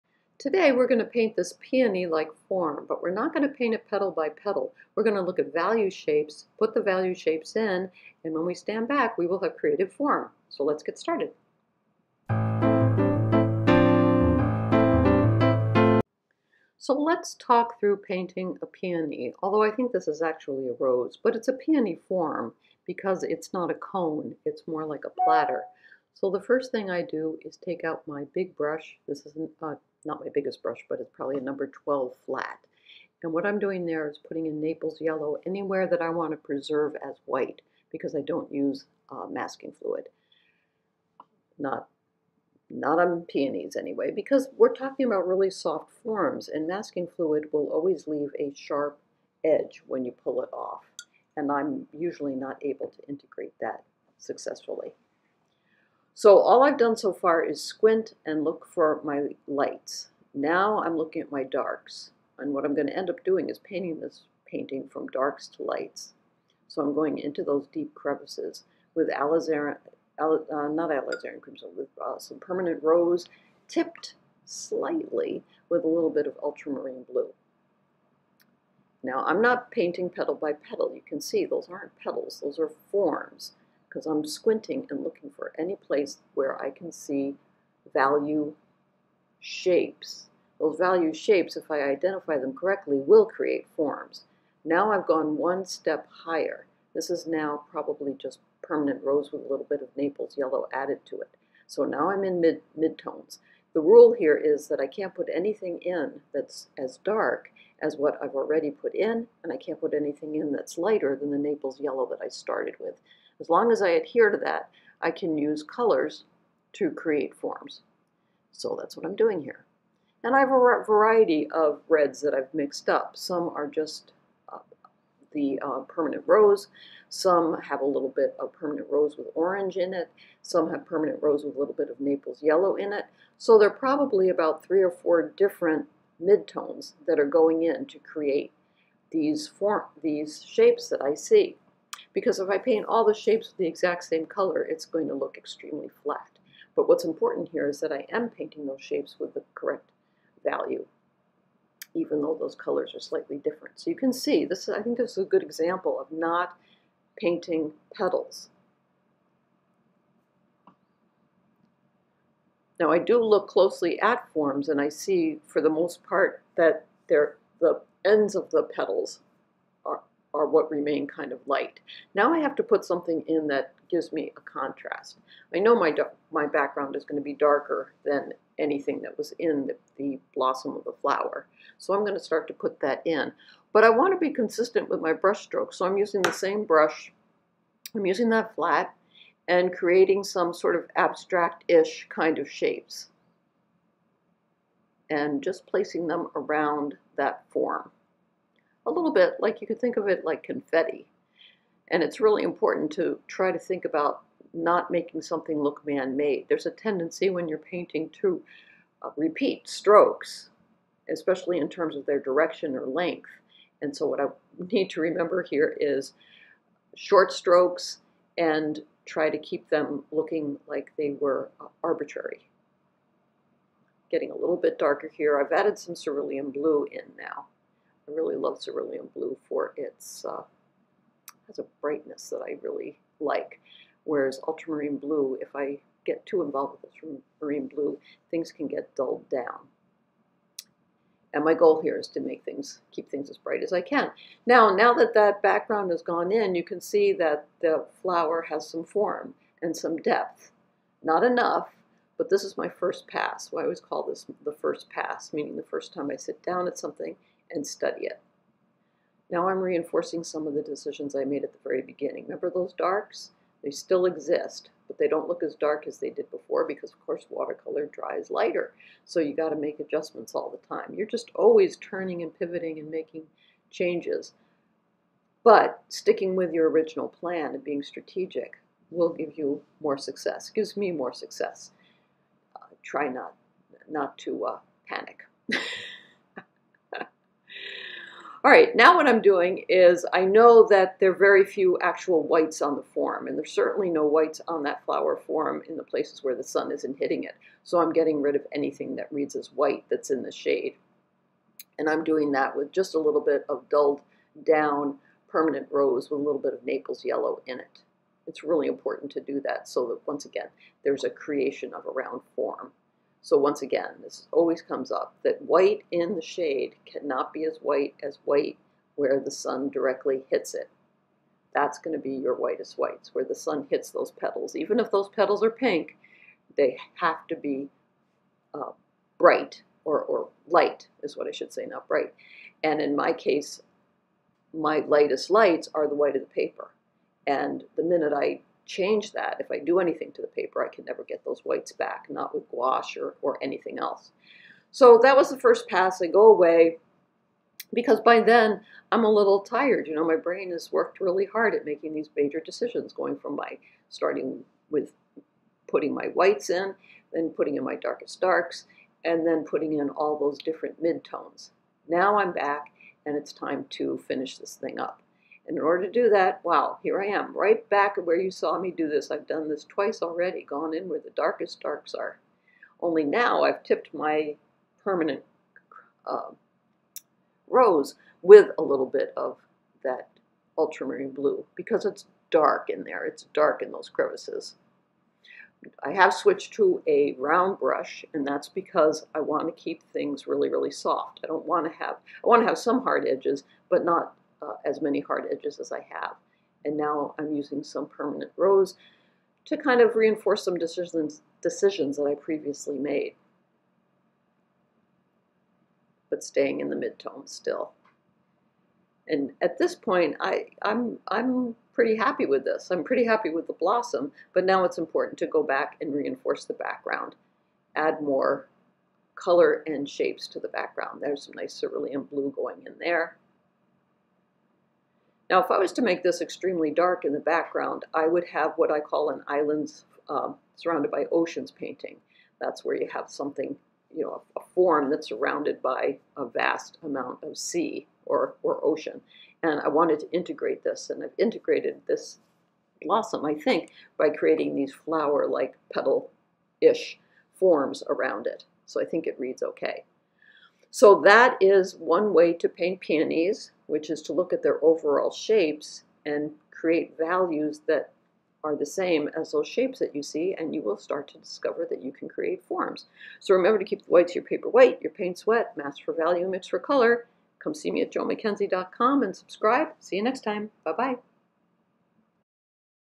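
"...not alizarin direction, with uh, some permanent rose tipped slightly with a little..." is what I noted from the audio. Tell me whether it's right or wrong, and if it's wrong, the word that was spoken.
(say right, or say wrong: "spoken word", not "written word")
wrong: "crimson", not "direction".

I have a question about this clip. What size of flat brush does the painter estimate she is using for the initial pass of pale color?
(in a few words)
number 12.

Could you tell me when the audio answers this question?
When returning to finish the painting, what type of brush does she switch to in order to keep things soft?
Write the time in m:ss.
6:27.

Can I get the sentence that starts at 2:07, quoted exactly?
Some have a little bit of permanent rose with orange in it.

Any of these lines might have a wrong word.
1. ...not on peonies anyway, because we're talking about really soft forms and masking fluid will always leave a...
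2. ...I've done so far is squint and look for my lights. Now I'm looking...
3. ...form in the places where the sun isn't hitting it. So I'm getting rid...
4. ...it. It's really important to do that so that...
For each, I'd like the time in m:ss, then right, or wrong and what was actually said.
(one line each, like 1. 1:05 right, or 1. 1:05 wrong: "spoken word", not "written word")
1. 0:42 right
2. 0:56 right
3. 4:55 right
4. 5:07 right.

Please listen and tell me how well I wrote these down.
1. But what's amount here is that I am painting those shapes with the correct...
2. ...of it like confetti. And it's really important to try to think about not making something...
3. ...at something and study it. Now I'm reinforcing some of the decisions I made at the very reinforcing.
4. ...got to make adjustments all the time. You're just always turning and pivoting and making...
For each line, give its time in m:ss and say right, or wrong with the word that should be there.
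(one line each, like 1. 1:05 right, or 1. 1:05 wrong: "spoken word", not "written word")
1. 2:26 wrong: "important", not "amount"
2. 3:19 right
3. 4:16 wrong: "beginning", not "reinforcing"
4. 4:29 right.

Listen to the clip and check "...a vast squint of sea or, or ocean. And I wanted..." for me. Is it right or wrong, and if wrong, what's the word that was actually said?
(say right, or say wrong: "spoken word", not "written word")
wrong: "amount", not "squint".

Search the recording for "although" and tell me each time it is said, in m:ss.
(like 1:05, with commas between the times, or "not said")
0:19.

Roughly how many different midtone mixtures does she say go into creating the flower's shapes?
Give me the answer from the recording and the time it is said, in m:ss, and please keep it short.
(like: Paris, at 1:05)
3 or 4, at 2:14.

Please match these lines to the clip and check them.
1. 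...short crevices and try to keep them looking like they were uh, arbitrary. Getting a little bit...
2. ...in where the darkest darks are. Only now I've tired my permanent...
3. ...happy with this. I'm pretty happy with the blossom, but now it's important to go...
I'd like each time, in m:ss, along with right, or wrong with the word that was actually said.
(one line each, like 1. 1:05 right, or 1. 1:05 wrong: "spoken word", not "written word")
1. 3:36 wrong: "strokes", not "crevices"
2. 6:10 wrong: "tipped", not "tired"
3. 6:51 right.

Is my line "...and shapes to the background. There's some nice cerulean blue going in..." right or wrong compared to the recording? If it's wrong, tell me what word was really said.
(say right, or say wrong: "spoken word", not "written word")
right.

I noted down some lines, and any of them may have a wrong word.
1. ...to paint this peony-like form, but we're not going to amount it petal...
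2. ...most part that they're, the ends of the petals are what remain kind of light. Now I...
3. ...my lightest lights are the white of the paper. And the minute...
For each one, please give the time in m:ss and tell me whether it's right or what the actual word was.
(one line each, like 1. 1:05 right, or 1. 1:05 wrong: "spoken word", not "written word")
1. 0:00 wrong: "paint", not "amount"
2. 2:45 right
3. 5:34 right.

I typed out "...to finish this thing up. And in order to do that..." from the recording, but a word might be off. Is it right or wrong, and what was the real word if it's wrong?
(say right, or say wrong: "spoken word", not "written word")
right.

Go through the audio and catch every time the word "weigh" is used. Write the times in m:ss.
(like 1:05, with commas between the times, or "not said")
not said.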